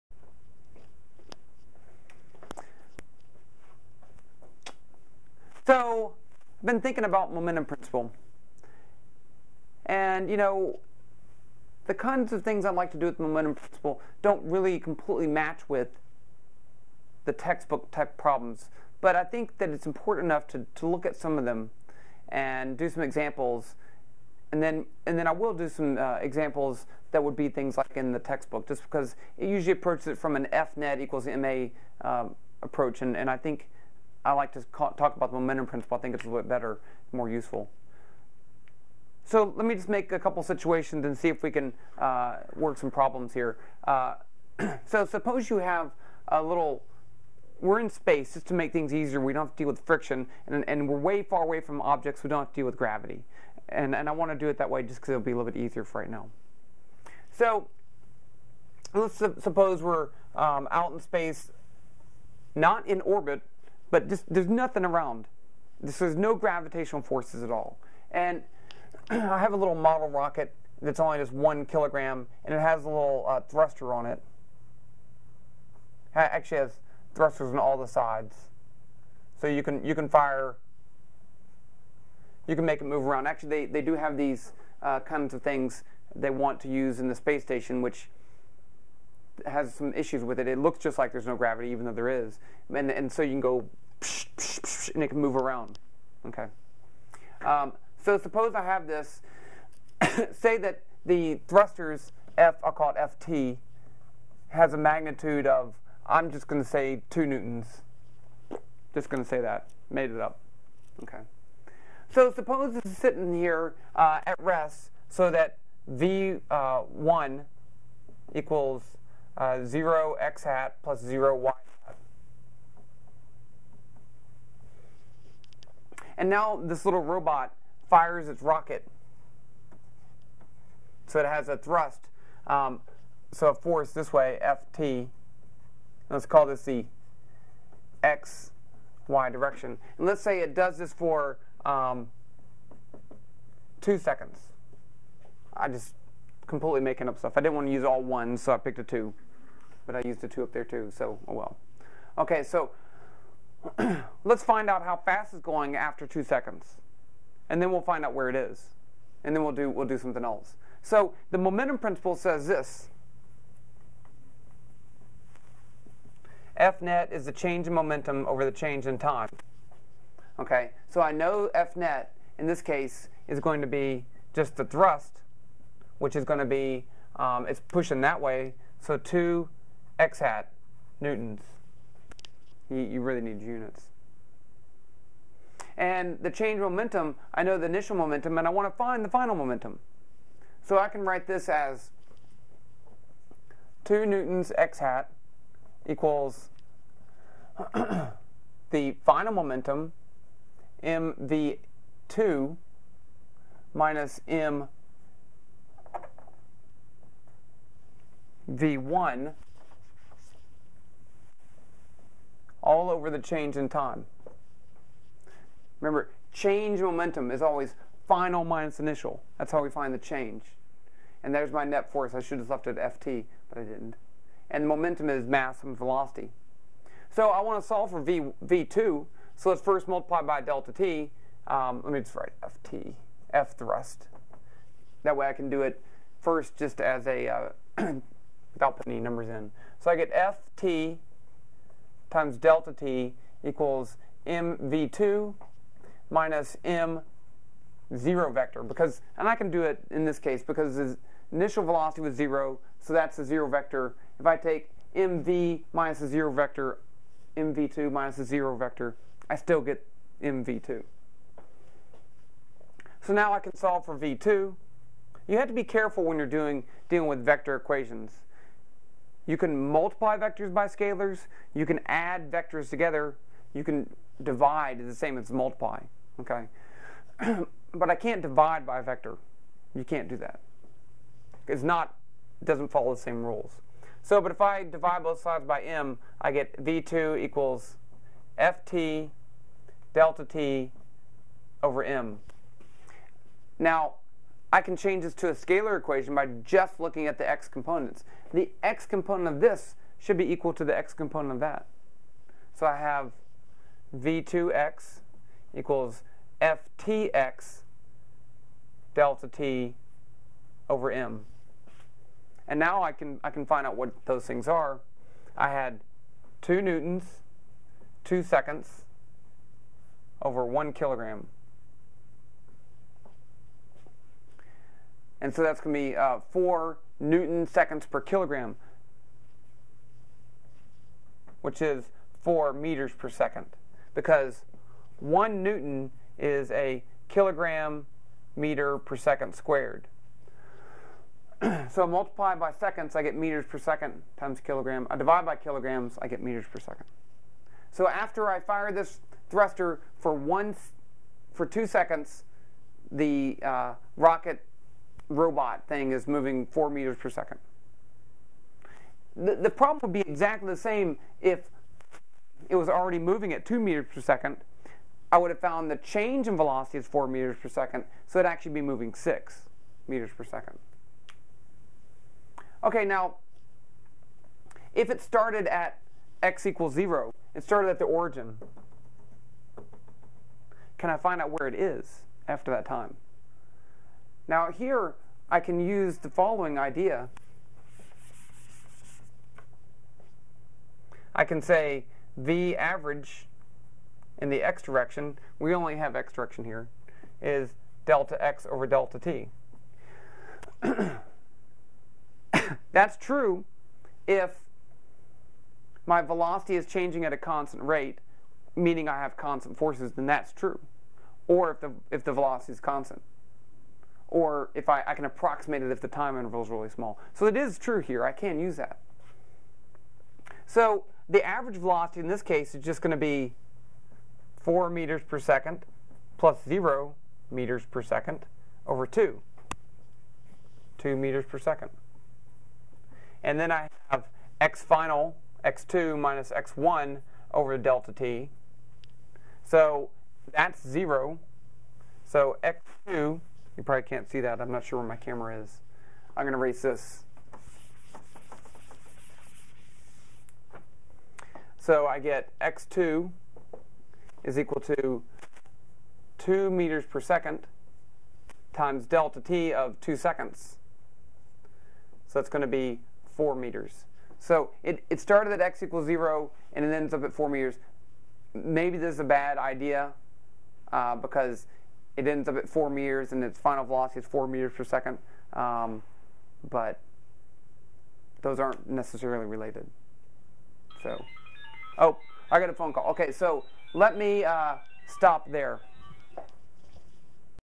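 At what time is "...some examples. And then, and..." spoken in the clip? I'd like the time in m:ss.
0:22.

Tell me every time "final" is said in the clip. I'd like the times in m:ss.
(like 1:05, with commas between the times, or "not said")
3:09, 3:19, 3:38, 7:14, 7:53.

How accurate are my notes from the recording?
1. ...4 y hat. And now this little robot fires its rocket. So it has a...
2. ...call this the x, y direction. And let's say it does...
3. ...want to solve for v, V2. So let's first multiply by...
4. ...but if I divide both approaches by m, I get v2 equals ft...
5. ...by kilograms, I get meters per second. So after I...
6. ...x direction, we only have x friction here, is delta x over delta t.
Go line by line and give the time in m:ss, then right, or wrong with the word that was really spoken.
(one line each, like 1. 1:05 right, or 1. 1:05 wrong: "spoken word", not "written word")
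1. 2:01 wrong: "0", not "4"
2. 2:16 right
3. 3:47 right
4. 4:44 wrong: "sides", not "approaches"
5. 5:45 right
6. 6:34 wrong: "direction", not "friction".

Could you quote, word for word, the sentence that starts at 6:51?
Or if the, if the velocity is constant or if I, I can approximate it if the time interval is really small.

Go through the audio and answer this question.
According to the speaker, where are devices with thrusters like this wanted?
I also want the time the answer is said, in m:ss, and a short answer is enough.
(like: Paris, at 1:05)
the space station, at 1:27.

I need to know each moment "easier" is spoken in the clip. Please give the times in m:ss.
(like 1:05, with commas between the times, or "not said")
0:48, 0:55.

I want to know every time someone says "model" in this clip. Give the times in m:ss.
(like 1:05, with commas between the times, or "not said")
1:09.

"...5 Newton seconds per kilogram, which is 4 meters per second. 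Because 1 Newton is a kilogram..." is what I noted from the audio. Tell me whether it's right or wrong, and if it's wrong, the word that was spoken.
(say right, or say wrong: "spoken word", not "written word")
wrong: "4", not "5".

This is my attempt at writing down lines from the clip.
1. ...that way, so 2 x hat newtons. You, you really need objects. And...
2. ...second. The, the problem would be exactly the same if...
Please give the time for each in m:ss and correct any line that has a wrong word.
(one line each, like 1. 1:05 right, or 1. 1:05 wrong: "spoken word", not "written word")
1. 2:58 wrong: "units", not "objects"
2. 5:57 right.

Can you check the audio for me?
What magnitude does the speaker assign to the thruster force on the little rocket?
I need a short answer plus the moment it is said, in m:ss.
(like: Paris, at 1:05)
2 newtons, at 1:47.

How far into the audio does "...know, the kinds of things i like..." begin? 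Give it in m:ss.
0:10.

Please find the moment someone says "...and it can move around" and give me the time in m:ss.
1:34.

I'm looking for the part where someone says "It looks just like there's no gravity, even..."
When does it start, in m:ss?
1:30.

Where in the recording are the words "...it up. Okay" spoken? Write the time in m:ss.
1:50.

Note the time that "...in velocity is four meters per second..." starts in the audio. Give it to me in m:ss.
6:06.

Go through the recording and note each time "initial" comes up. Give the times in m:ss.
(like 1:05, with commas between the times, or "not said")
3:07, 3:38, 4:11.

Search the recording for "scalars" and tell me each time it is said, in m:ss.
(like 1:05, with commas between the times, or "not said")
4:30, 4:55.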